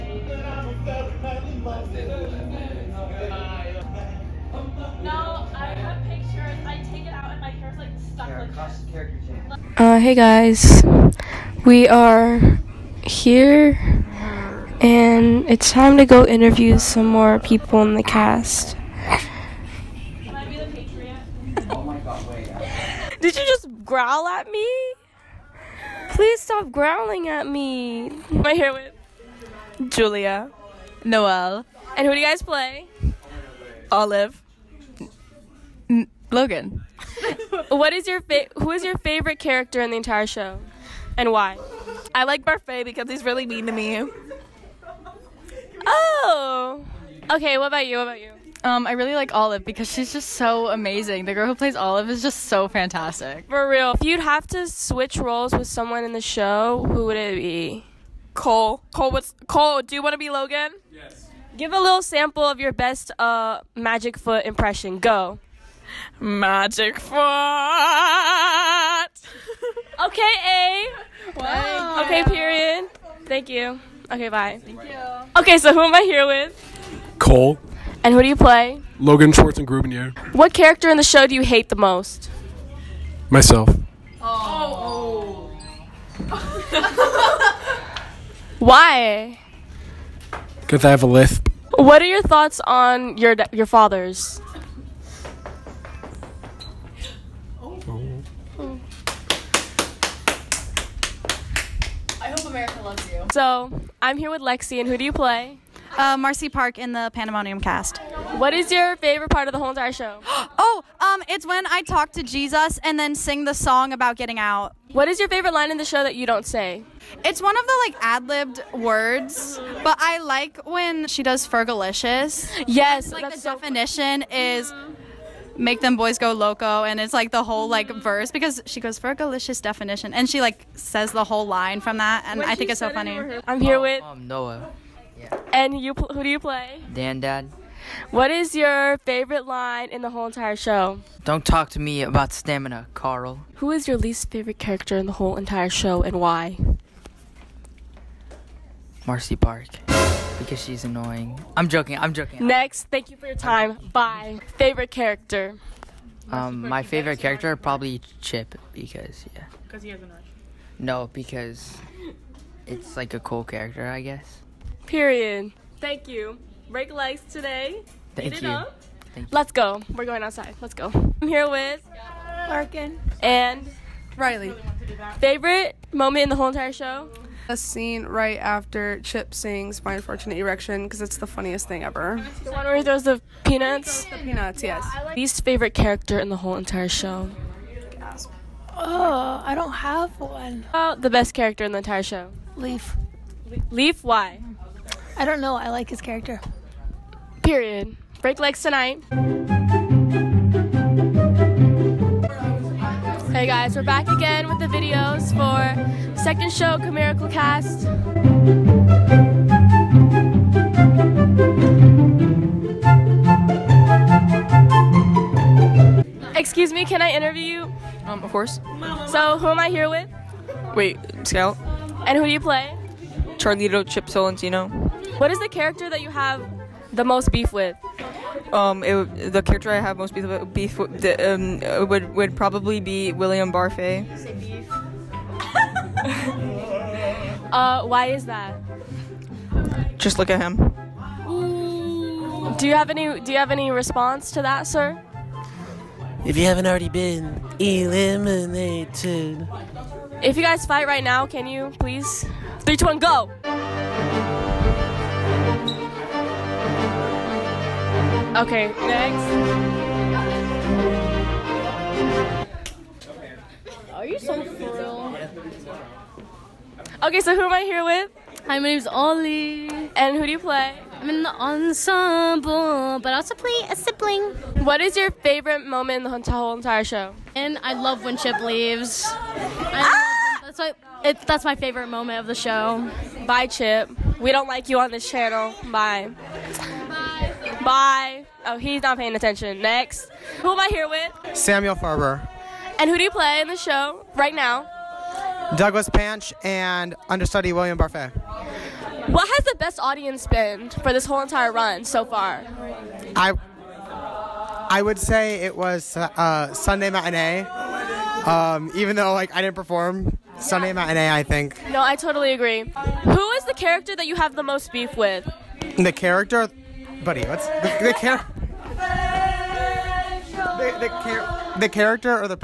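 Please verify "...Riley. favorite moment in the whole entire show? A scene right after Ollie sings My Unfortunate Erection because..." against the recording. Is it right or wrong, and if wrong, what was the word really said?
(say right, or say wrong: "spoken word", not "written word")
wrong: "Chip", not "Ollie".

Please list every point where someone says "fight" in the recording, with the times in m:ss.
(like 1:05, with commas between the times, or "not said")
4:10.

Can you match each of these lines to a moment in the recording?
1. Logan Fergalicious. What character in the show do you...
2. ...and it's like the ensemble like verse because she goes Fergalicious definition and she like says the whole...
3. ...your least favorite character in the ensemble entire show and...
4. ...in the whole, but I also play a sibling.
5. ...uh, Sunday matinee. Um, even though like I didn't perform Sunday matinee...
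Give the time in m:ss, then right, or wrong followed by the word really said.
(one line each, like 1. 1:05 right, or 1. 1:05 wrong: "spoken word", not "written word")
1. 1:18 wrong: "Schwartzandgrubenierre", not "Fergalicious"
2. 2:06 wrong: "whole", not "ensemble"
3. 2:23 wrong: "whole", not "ensemble"
4. 4:31 wrong: "ensemble", not "whole"
5. 5:05 right.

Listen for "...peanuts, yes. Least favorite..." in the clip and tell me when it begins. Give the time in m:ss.
3:04.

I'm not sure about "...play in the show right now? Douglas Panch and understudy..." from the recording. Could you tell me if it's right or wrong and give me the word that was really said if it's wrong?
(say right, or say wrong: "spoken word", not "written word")
right.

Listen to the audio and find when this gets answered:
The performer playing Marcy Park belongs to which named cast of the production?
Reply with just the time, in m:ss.
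1:47.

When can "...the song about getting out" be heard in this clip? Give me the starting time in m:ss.
1:53.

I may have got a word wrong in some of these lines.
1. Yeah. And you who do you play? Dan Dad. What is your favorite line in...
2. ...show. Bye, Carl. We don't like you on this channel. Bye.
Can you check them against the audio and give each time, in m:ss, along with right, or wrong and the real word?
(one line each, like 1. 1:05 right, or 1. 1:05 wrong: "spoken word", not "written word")
1. 2:15 right
2. 4:42 wrong: "Chip", not "Carl".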